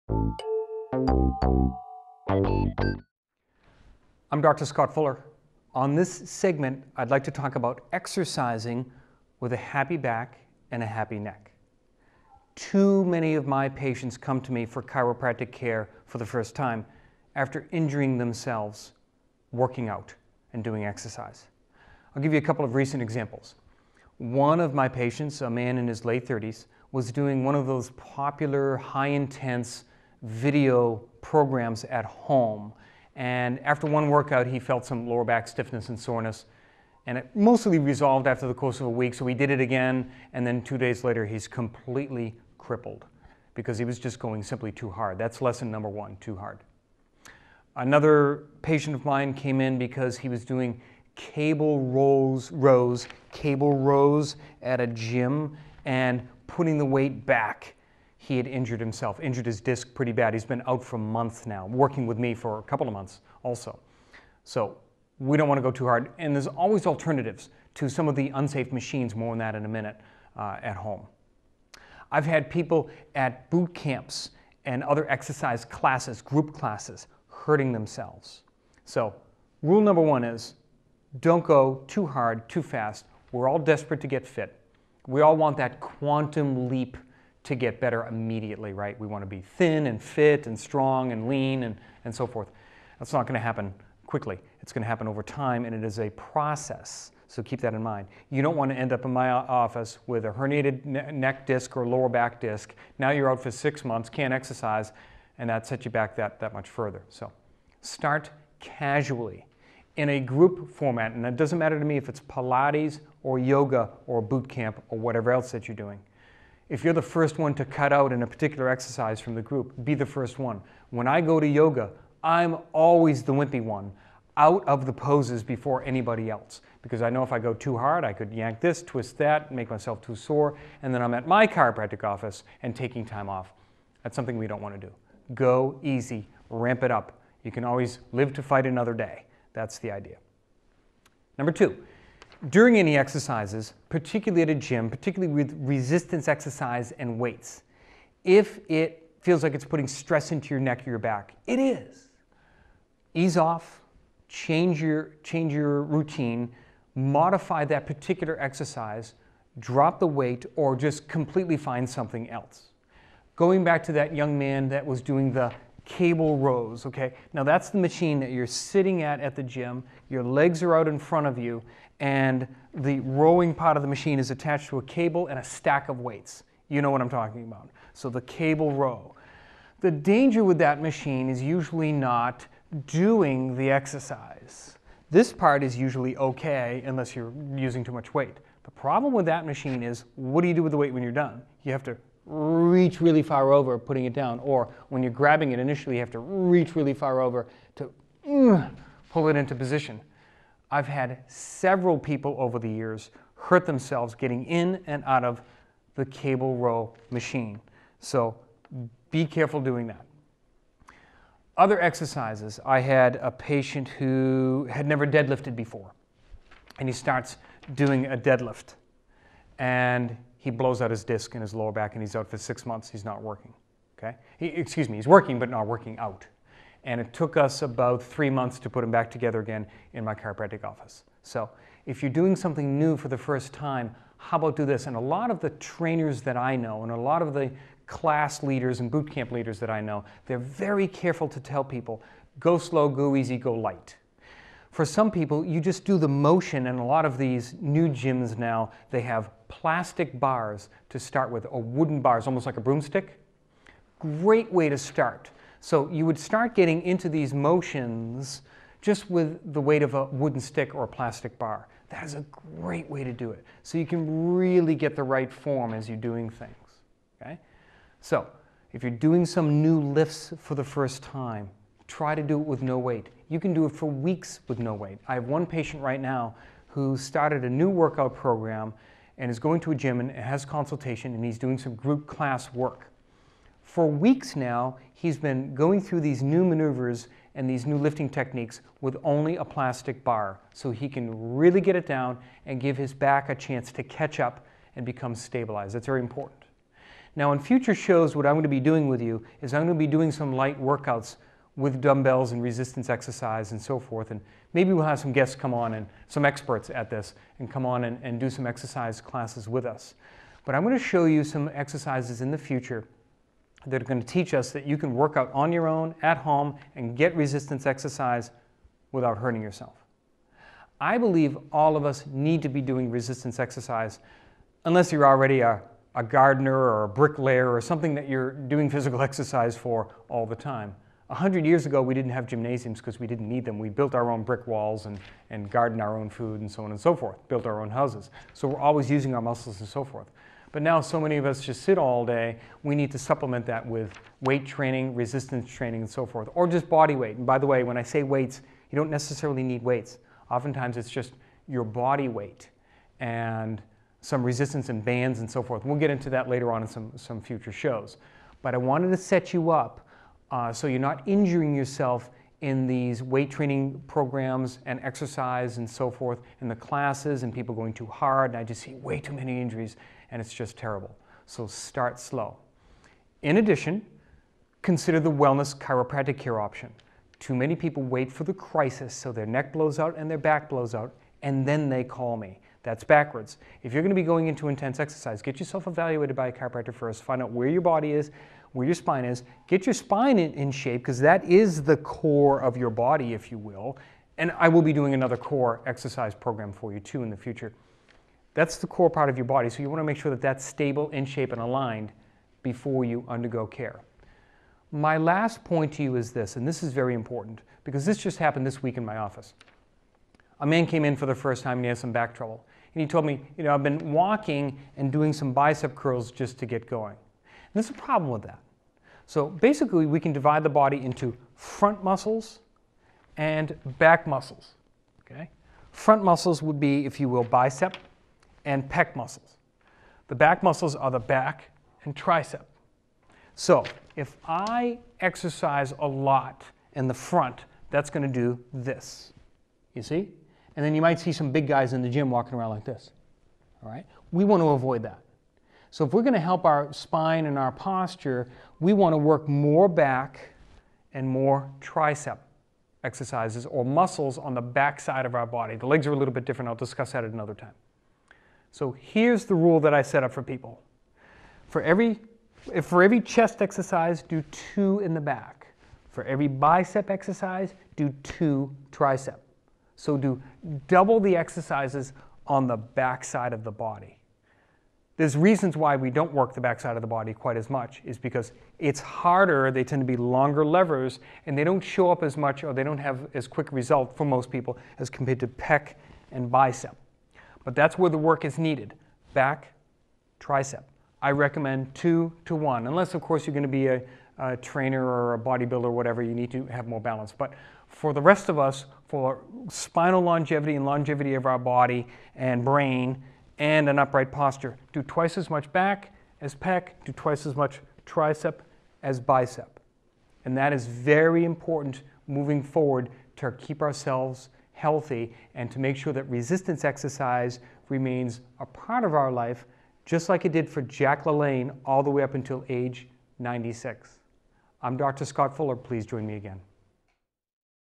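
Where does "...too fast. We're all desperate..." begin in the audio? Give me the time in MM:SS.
01:22.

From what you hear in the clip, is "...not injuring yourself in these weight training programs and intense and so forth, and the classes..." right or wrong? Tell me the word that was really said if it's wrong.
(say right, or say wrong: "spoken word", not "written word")
wrong: "exercise", not "intense".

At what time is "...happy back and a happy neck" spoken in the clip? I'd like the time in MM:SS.
00:09.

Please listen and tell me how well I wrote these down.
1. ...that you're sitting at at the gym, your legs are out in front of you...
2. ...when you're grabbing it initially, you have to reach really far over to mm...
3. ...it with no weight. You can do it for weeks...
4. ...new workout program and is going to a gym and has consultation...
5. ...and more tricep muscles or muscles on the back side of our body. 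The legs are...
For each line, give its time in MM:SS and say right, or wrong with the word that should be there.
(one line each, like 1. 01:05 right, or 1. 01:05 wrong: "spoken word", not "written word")
1. 02:48 right
2. 03:14 right
3. 04:32 right
4. 04:37 right
5. 07:30 wrong: "exercises", not "muscles".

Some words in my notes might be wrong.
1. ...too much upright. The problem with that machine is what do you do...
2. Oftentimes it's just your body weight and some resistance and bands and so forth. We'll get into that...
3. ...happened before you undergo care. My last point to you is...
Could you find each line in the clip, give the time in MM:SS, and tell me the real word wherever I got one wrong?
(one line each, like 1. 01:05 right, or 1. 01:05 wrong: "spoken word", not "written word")
1. 03:07 wrong: "weight", not "upright"
2. 05:50 right
3. 06:41 wrong: "aligned", not "happened".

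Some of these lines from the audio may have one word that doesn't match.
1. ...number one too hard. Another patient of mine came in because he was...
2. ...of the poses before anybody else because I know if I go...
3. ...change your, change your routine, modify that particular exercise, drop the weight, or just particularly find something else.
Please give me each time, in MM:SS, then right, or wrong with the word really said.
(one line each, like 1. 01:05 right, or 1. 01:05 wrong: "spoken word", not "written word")
1. 00:45 right
2. 02:04 right
3. 02:34 wrong: "completely", not "particularly".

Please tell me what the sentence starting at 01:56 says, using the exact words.
If you're the first one to cut out in a particular exercise from the group, be the first one.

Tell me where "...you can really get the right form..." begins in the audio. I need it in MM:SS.
04:23.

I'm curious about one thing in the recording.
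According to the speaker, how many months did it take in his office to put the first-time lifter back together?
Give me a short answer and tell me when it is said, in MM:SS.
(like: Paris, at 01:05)
3, at 03:48.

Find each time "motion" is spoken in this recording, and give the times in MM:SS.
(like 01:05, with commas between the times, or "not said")
04:06, 04:17.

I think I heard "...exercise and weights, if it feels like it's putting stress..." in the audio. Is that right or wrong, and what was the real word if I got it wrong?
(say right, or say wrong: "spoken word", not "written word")
right.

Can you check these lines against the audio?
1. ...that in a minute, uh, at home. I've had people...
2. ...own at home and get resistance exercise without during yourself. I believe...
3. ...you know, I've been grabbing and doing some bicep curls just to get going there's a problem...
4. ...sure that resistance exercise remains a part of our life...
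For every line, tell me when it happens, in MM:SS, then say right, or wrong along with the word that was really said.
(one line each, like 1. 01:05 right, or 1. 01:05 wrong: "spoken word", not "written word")
1. 01:09 right
2. 05:15 wrong: "hurting", not "during"
3. 06:53 wrong: "walking", not "grabbing"
4. 08:35 right.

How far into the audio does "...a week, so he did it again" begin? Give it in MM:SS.
00:38.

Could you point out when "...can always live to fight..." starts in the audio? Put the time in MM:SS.
02:17.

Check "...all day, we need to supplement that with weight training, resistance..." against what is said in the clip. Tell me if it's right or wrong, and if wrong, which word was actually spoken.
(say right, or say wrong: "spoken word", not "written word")
right.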